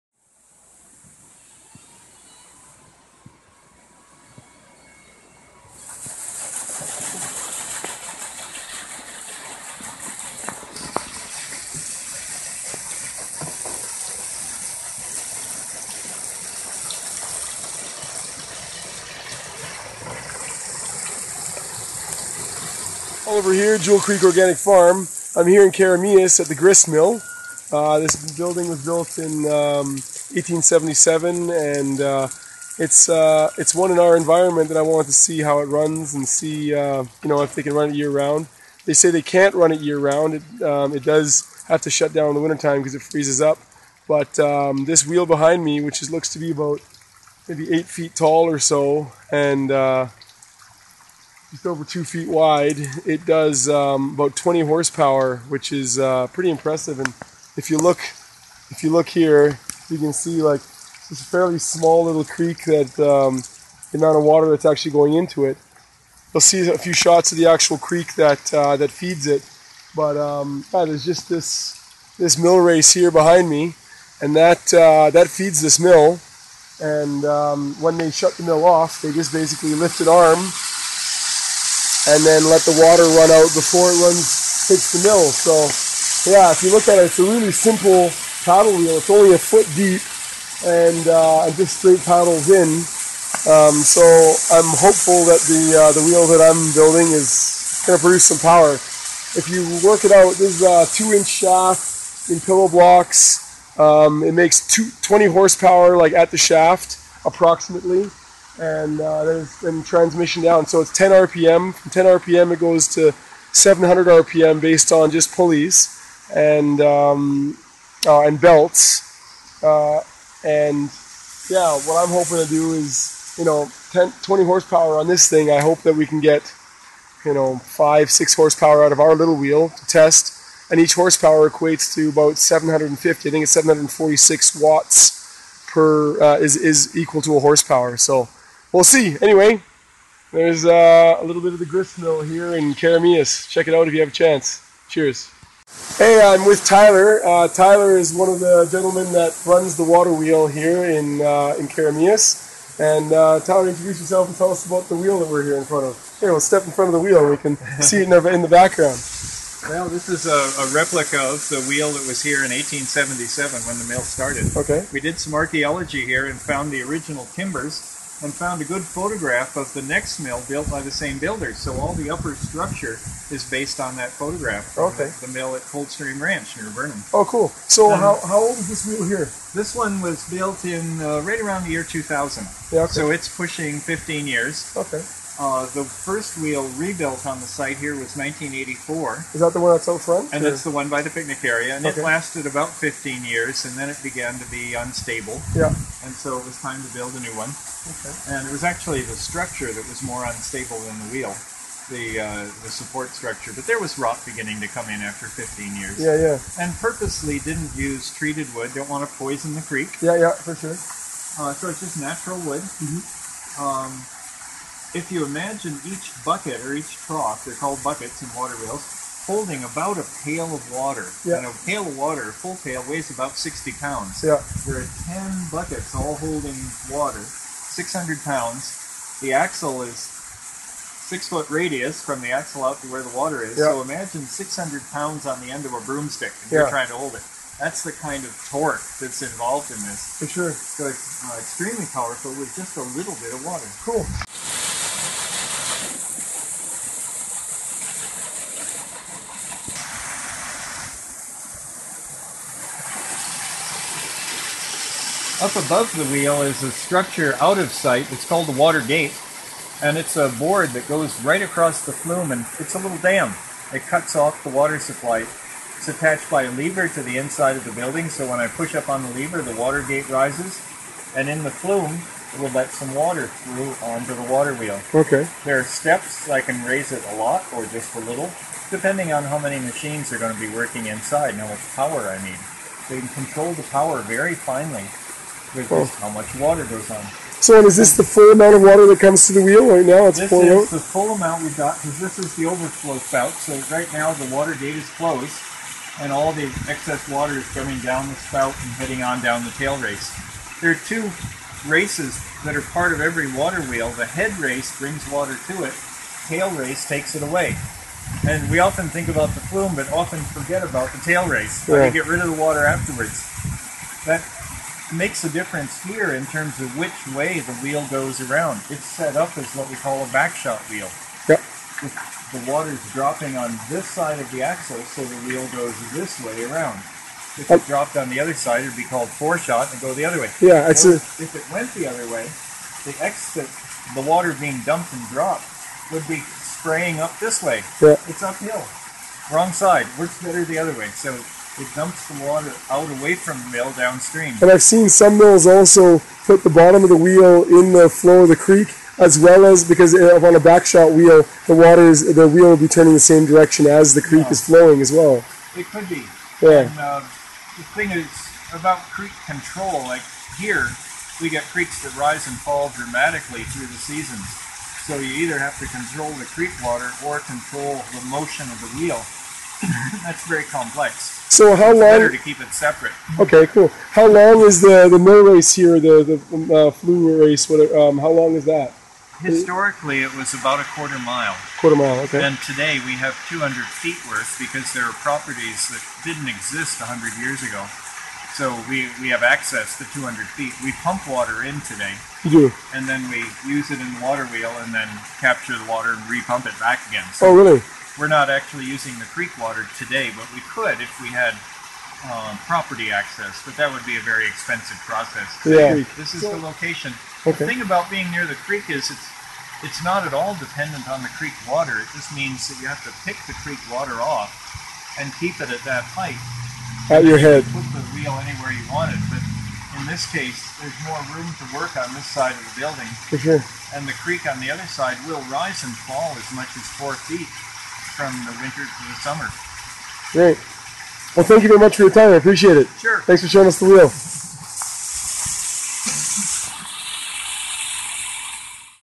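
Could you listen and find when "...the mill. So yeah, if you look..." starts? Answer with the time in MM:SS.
01:24.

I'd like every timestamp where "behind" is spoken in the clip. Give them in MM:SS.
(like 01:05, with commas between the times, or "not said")
00:45, 01:13.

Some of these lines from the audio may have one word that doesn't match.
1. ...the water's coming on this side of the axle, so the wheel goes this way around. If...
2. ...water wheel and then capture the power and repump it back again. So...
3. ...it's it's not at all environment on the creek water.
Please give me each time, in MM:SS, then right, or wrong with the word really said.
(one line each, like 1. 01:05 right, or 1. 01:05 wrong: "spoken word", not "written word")
1. 05:22 wrong: "dropping", not "coming"
2. 06:34 wrong: "water", not "power"
3. 06:48 wrong: "dependent", not "environment".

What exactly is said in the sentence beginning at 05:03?
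The head race brings water to it, tail race takes it away.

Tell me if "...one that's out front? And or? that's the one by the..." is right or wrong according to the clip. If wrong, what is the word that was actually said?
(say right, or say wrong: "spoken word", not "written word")
right.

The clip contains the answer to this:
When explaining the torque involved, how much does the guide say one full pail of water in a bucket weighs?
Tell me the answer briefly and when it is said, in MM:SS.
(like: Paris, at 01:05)
60 pounds, at 03:43.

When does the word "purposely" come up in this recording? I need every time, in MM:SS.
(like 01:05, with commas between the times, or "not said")
03:26.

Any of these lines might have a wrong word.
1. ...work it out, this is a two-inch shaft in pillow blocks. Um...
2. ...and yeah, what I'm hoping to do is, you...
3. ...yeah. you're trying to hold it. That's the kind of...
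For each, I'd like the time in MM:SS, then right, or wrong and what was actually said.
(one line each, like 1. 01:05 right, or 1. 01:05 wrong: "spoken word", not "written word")
1. 01:39 right
2. 02:00 right
3. 03:56 right.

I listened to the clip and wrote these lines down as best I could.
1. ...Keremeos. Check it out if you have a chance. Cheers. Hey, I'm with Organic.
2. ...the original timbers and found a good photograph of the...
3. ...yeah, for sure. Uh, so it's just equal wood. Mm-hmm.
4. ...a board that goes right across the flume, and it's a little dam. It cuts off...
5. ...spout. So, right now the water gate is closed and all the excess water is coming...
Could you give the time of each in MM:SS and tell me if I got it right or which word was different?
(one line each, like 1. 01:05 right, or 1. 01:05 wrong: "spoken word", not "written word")
1. 02:22 wrong: "Tyler", not "Organic"
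2. 02:46 right
3. 03:30 wrong: "natural", not "equal"
4. 04:20 right
5. 04:52 right.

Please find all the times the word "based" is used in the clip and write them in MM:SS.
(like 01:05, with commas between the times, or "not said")
01:54, 02:53.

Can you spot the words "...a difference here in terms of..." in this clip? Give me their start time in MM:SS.
05:15.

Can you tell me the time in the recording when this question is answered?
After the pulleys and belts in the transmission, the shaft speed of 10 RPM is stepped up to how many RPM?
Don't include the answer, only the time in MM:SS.
01:53.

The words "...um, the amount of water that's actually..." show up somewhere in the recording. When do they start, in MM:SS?
01:02.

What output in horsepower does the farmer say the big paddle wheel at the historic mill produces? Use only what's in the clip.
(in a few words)
20 horsepower.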